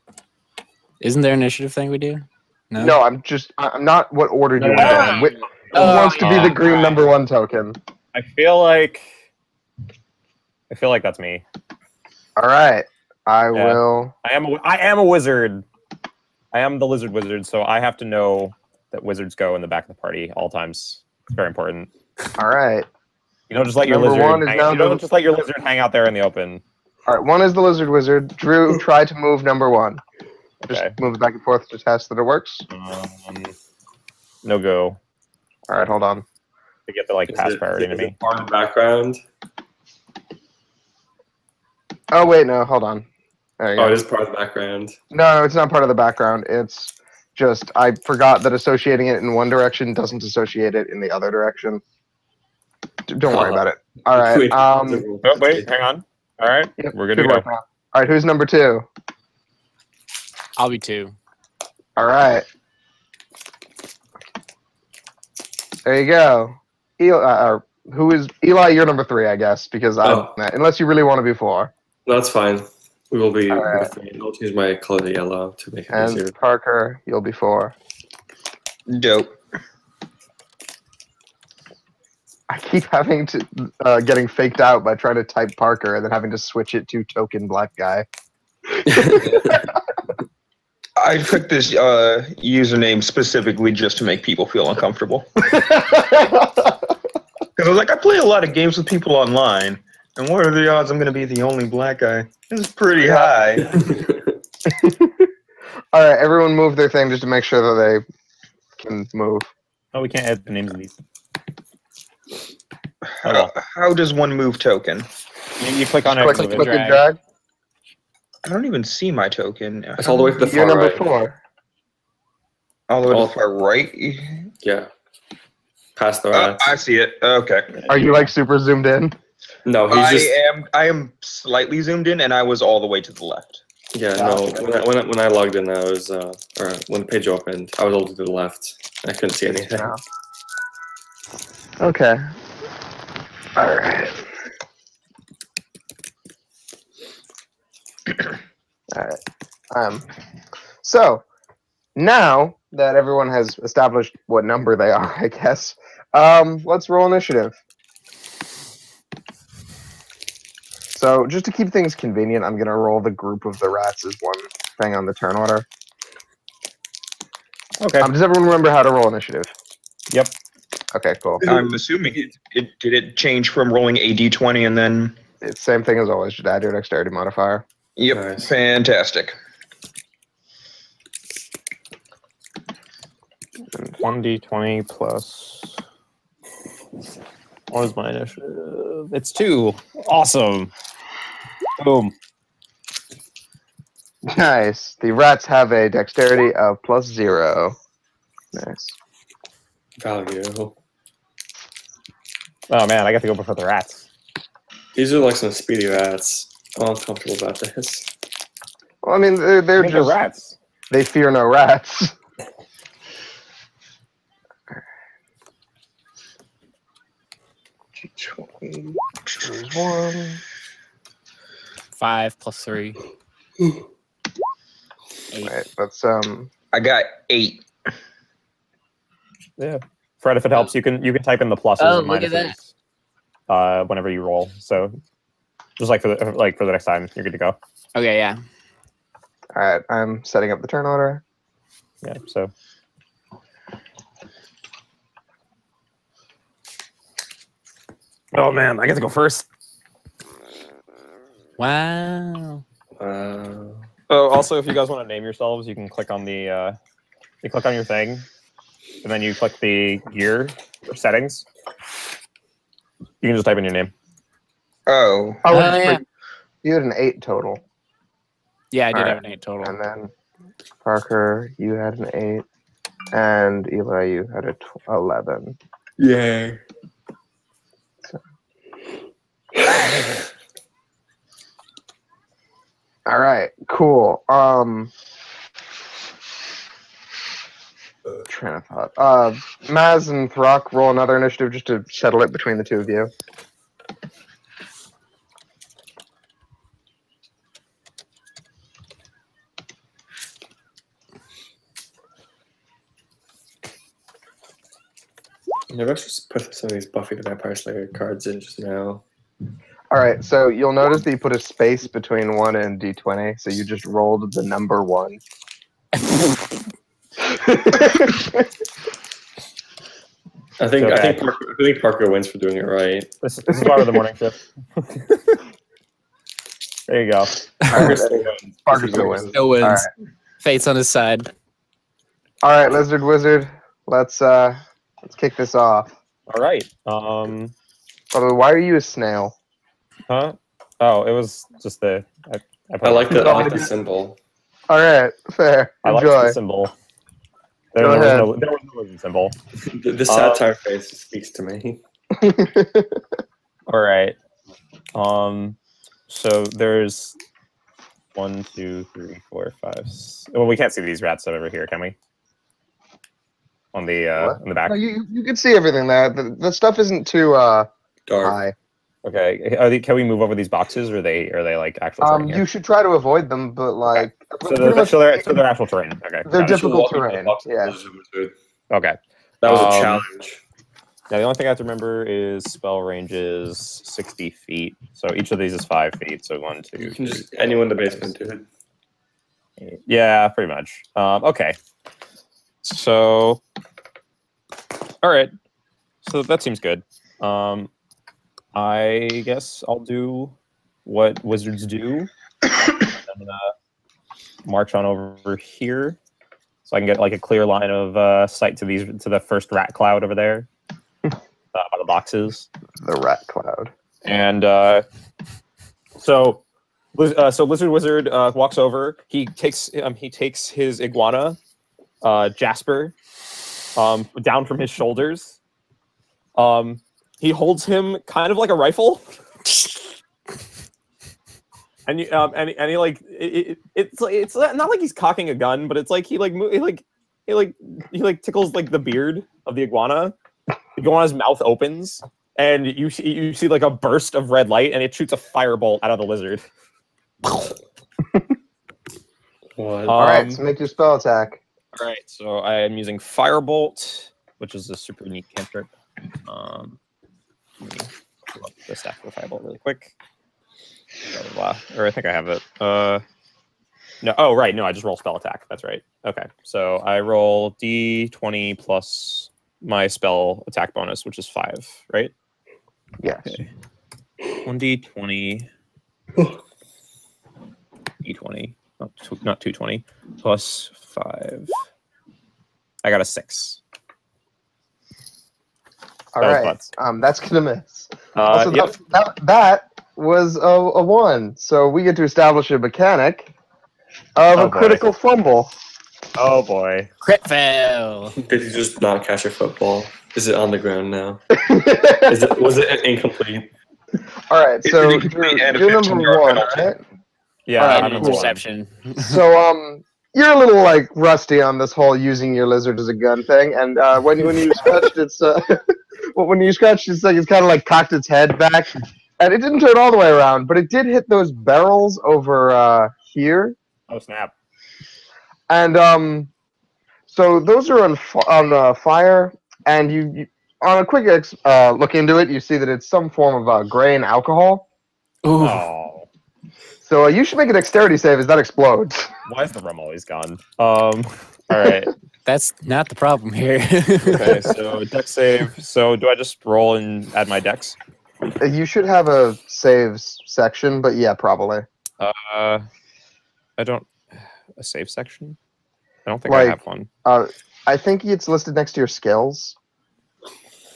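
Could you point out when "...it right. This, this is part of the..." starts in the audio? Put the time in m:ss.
5:22.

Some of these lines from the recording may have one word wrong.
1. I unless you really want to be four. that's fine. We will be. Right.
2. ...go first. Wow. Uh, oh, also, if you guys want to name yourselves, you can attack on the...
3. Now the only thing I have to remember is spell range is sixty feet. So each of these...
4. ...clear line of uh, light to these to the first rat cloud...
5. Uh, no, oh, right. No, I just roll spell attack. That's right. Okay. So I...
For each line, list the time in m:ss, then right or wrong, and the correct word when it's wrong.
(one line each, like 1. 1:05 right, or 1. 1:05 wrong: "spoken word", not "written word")
1. 1:10 right
2. 4:09 wrong: "click", not "attack"
3. 6:21 right
4. 6:47 wrong: "sight", not "light"
5. 7:42 right.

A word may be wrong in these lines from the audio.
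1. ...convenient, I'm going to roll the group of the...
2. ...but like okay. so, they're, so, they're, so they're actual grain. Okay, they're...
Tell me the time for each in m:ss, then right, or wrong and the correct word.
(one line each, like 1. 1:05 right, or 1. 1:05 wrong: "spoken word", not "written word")
1. 2:41 right
2. 6:13 wrong: "terrain", not "grain".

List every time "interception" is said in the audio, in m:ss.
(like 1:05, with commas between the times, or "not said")
8:27.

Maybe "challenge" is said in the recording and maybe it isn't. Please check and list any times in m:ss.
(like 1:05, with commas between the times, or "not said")
6:19.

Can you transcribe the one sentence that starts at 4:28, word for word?
Yeah, I did have an eight total.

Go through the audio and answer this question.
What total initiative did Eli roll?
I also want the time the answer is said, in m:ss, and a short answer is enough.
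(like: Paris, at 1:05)
11, at 4:34.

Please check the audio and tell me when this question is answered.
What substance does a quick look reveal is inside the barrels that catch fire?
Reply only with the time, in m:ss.
8:53.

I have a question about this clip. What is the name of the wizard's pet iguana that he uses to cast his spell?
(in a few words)
Jasper.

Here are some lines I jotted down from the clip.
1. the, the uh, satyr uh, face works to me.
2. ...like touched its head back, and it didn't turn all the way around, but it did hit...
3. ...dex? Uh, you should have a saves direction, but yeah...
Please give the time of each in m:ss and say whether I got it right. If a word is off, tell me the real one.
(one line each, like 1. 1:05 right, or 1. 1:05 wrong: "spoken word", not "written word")
1. 5:49 wrong: "speaks", not "works"
2. 8:37 wrong: "cocked", not "touched"
3. 9:07 wrong: "section", not "direction".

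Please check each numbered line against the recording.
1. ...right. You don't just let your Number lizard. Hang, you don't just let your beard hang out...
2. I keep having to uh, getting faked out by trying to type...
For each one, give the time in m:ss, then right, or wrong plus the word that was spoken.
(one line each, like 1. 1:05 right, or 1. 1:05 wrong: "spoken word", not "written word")
1. 0:22 wrong: "lizard", not "beard"
2. 1:22 right.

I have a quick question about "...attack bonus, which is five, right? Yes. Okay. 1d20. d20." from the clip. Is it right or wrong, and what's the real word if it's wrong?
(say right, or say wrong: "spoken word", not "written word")
right.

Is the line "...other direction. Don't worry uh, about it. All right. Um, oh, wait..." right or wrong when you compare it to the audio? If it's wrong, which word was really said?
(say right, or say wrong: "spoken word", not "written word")
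right.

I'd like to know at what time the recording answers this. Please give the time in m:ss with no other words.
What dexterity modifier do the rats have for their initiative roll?
3:16.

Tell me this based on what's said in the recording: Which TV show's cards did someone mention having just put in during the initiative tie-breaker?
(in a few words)
Buffy the Vampire Slayer.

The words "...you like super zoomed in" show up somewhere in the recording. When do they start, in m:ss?
2:07.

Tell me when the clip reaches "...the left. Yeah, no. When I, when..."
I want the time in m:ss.
2:13.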